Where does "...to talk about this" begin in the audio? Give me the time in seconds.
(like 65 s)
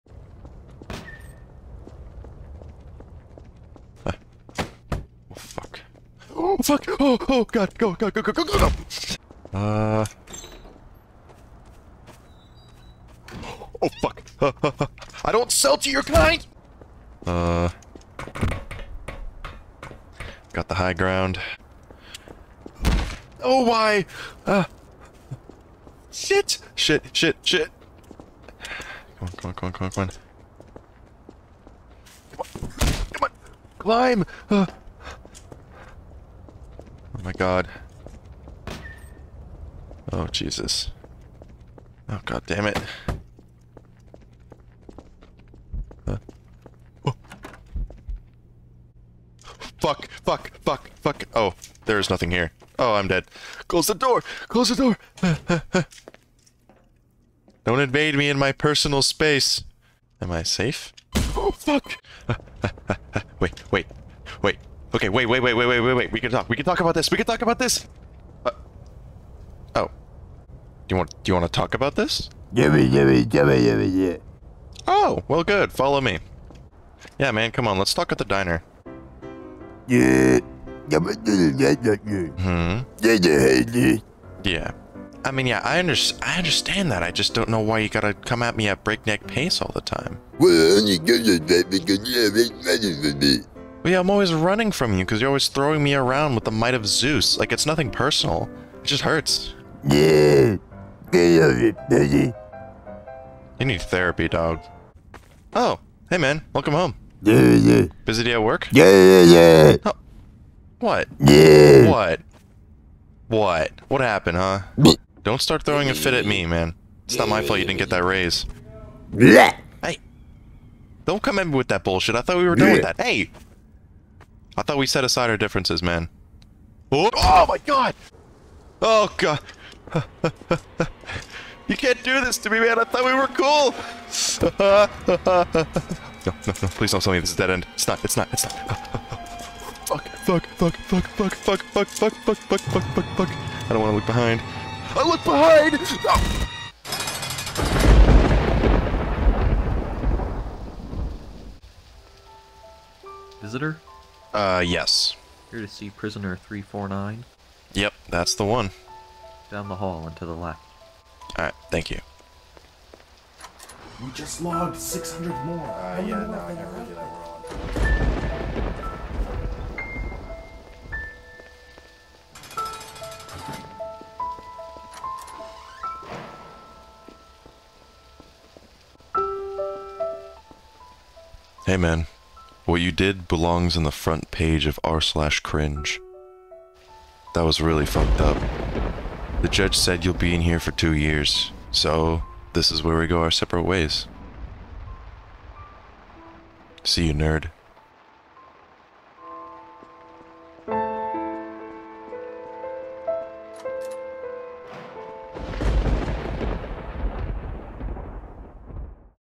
71 s.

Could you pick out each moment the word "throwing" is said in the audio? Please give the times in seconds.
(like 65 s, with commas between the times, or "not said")
95 s, 115 s.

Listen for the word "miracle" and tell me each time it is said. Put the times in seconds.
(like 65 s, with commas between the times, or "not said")
not said.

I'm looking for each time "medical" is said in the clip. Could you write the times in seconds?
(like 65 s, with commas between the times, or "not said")
not said.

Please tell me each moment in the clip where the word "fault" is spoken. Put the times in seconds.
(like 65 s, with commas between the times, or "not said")
117 s.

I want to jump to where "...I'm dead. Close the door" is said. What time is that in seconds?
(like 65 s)
52 s.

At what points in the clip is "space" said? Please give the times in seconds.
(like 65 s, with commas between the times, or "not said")
59 s.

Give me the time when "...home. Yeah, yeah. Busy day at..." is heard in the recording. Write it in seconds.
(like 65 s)
106 s.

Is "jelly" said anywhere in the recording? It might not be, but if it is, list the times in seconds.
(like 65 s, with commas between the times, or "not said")
not said.